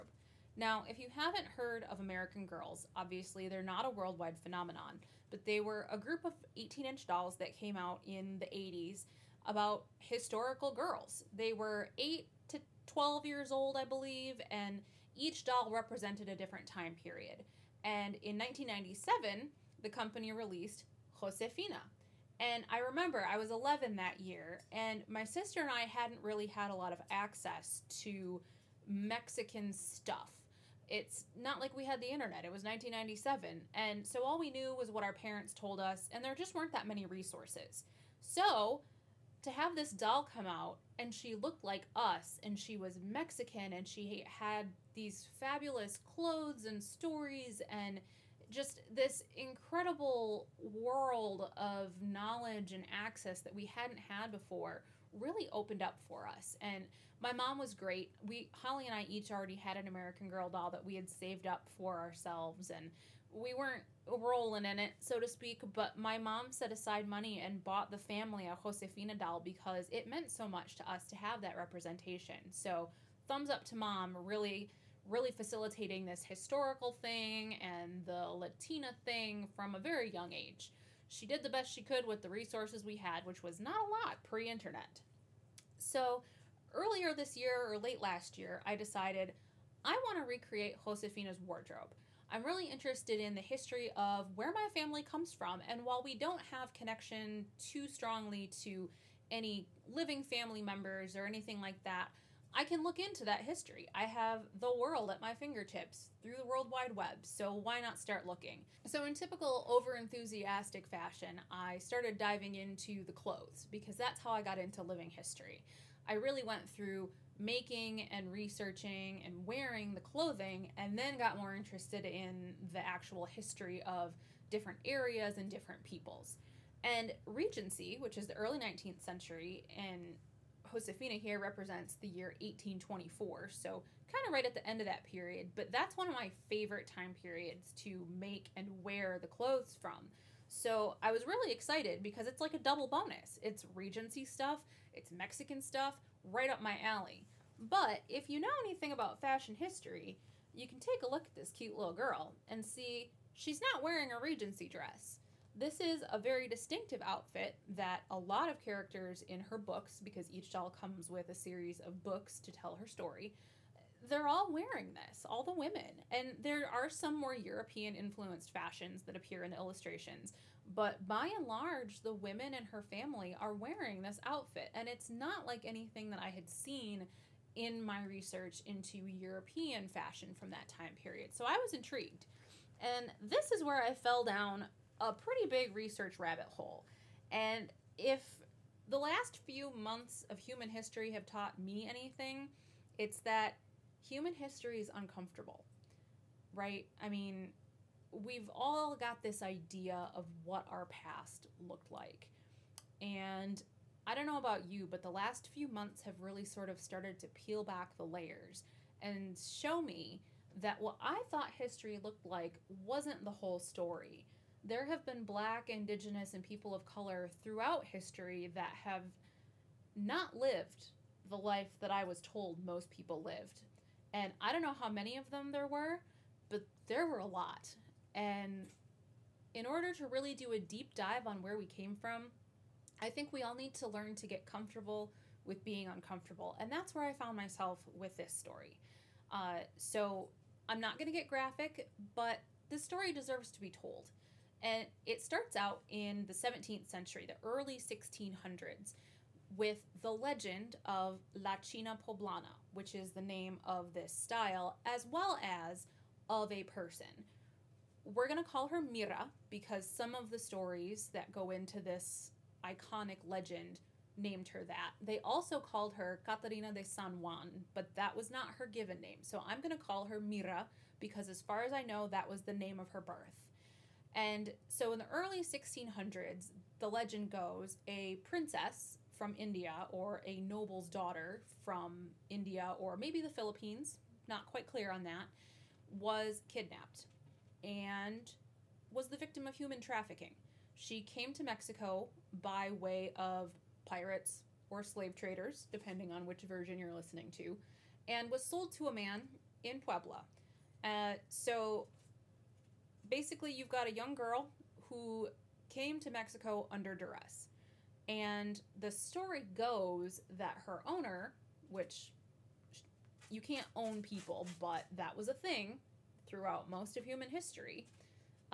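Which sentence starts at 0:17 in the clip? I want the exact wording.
And in 1997, the company released Josefina.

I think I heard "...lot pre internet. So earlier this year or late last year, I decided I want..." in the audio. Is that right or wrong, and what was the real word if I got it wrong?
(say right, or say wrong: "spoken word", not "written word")
right.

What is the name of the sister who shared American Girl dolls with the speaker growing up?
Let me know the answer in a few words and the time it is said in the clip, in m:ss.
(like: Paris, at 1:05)
Holly, at 0:58.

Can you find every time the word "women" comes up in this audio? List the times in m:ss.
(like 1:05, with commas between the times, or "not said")
2:45, 2:52.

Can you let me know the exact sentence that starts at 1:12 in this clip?
So, thumbs up to mom, really really facilitating this historical thing and the Latina thing from a very young age.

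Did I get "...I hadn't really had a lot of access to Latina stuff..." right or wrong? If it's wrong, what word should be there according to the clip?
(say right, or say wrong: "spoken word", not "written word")
wrong: "Mexican", not "Latina".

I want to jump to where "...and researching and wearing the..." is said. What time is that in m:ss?
1:58.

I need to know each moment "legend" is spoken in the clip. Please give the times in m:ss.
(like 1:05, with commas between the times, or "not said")
4:10, 4:23, 4:36.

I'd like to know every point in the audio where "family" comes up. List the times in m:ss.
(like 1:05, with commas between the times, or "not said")
1:07, 1:34, 1:40, 2:52.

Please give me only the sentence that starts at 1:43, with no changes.
I have the world at my fingertips through the World Wide Web, so why not start looking?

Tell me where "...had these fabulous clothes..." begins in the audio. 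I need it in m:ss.
0:44.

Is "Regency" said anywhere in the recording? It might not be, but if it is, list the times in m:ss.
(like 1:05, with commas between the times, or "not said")
2:07, 2:23, 2:34.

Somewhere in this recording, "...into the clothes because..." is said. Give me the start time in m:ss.
1:52.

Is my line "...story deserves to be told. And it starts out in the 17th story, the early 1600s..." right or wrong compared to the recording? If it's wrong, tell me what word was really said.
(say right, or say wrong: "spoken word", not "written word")
wrong: "century", not "story".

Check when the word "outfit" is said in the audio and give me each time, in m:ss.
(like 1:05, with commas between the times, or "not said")
2:37, 2:54.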